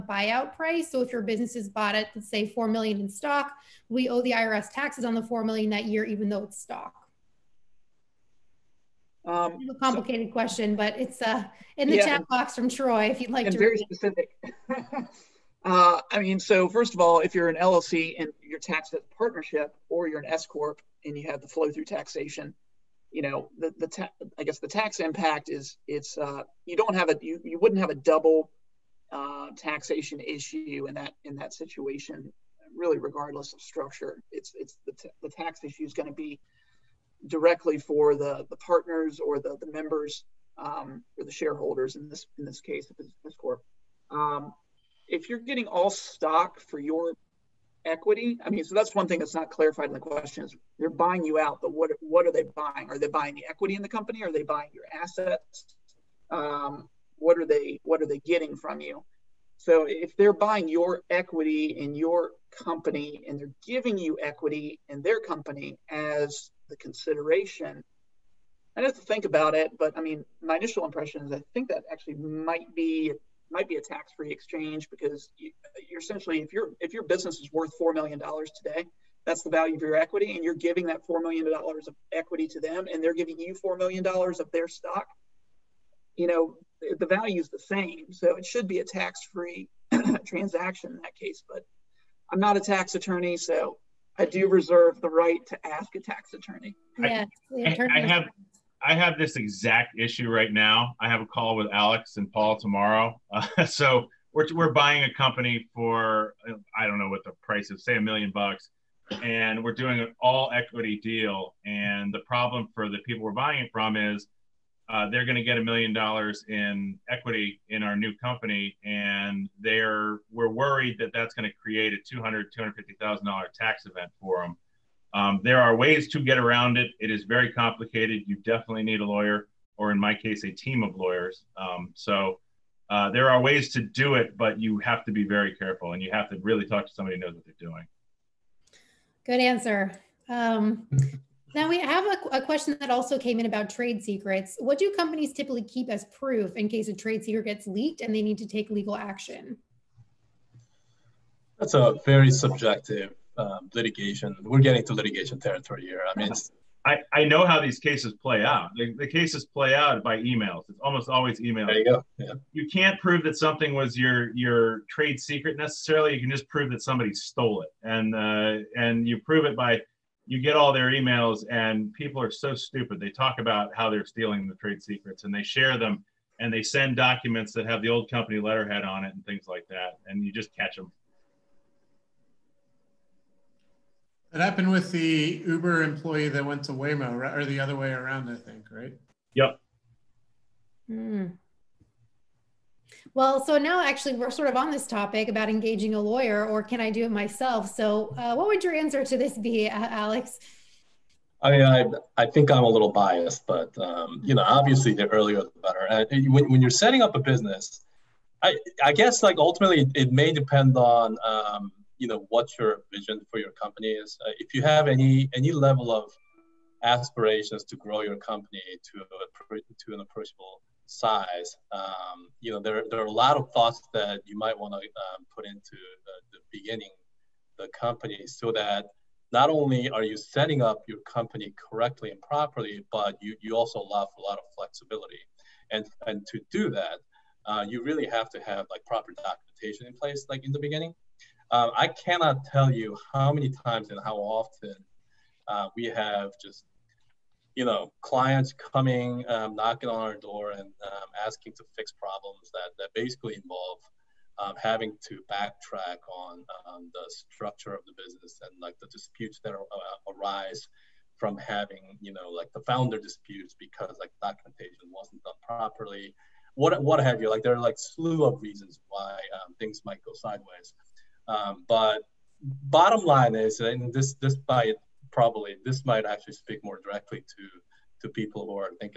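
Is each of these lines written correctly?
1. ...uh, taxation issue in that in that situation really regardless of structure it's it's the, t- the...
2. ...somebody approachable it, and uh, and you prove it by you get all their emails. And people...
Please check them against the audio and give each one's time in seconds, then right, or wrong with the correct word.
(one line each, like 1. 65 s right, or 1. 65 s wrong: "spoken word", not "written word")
1. 29 s right
2. 166 s wrong: "stole", not "approachable".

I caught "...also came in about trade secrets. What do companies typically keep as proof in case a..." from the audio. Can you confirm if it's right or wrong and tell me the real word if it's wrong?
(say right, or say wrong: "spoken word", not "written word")
right.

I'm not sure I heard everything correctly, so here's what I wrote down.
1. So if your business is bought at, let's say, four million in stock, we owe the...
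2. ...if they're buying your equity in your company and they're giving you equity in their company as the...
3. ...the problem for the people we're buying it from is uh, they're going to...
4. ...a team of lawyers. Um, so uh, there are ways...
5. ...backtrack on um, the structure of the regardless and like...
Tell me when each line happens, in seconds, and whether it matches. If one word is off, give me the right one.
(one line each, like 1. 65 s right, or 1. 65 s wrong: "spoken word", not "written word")
1. 0 s right
2. 59 s right
3. 112 s right
4. 130 s right
5. 255 s wrong: "business", not "regardless".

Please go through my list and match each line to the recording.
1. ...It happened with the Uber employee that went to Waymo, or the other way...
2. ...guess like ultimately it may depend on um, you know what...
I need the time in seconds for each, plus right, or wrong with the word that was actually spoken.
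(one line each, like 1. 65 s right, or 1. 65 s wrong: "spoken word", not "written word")
1. 184 s right
2. 208 s right.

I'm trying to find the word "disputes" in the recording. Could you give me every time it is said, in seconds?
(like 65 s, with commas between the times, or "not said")
258 s, 262 s.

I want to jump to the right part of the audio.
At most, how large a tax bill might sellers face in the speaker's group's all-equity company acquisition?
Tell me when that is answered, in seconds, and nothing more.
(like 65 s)
122 s.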